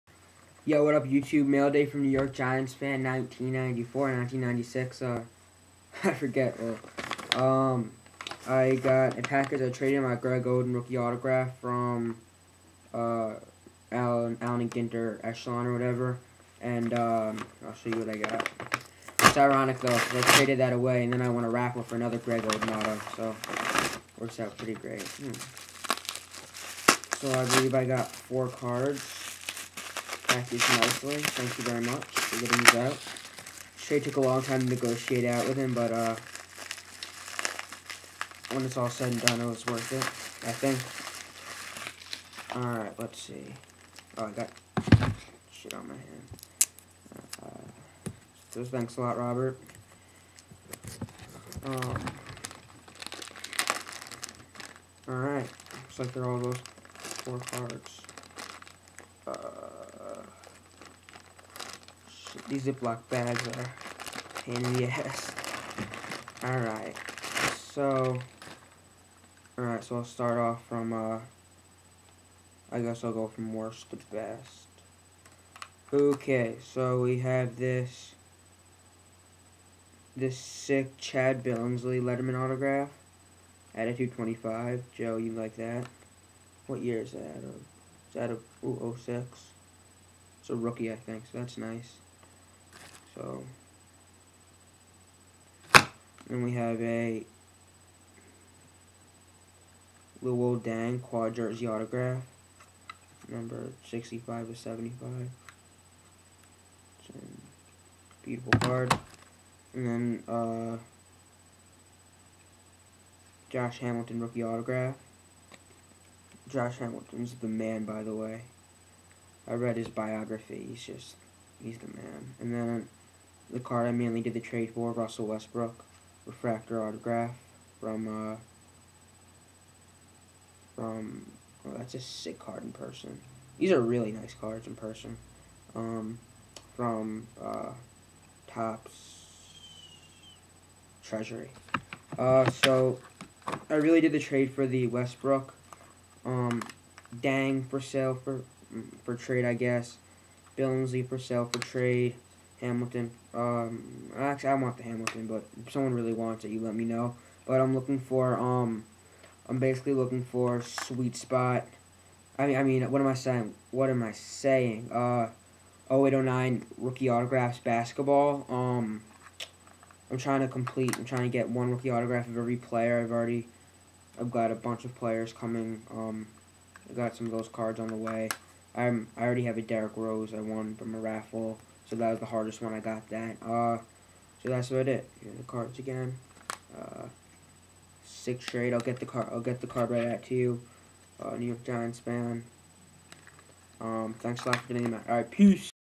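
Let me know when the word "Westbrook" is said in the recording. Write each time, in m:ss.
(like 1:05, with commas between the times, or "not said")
2:05, 2:24.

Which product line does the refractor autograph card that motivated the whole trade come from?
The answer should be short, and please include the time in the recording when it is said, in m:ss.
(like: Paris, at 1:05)
Topps Treasury, at 2:18.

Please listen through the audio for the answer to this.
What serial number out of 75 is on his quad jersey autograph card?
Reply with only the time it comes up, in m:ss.
1:43.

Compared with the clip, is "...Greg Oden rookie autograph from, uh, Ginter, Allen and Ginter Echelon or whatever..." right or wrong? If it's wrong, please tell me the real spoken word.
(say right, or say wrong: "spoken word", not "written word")
wrong: "Allen", not "Ginter".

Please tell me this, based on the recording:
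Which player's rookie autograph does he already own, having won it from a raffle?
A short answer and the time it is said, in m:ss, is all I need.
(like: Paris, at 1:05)
Derrick Rose, at 2:59.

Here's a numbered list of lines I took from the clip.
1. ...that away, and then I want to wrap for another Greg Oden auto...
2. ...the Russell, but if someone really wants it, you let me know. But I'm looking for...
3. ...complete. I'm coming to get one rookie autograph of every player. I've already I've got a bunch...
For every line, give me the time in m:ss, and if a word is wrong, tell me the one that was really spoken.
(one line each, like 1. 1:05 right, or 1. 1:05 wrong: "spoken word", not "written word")
1. 0:20 right
2. 2:34 wrong: "Hamilton", not "Russell"
3. 2:50 wrong: "trying", not "coming".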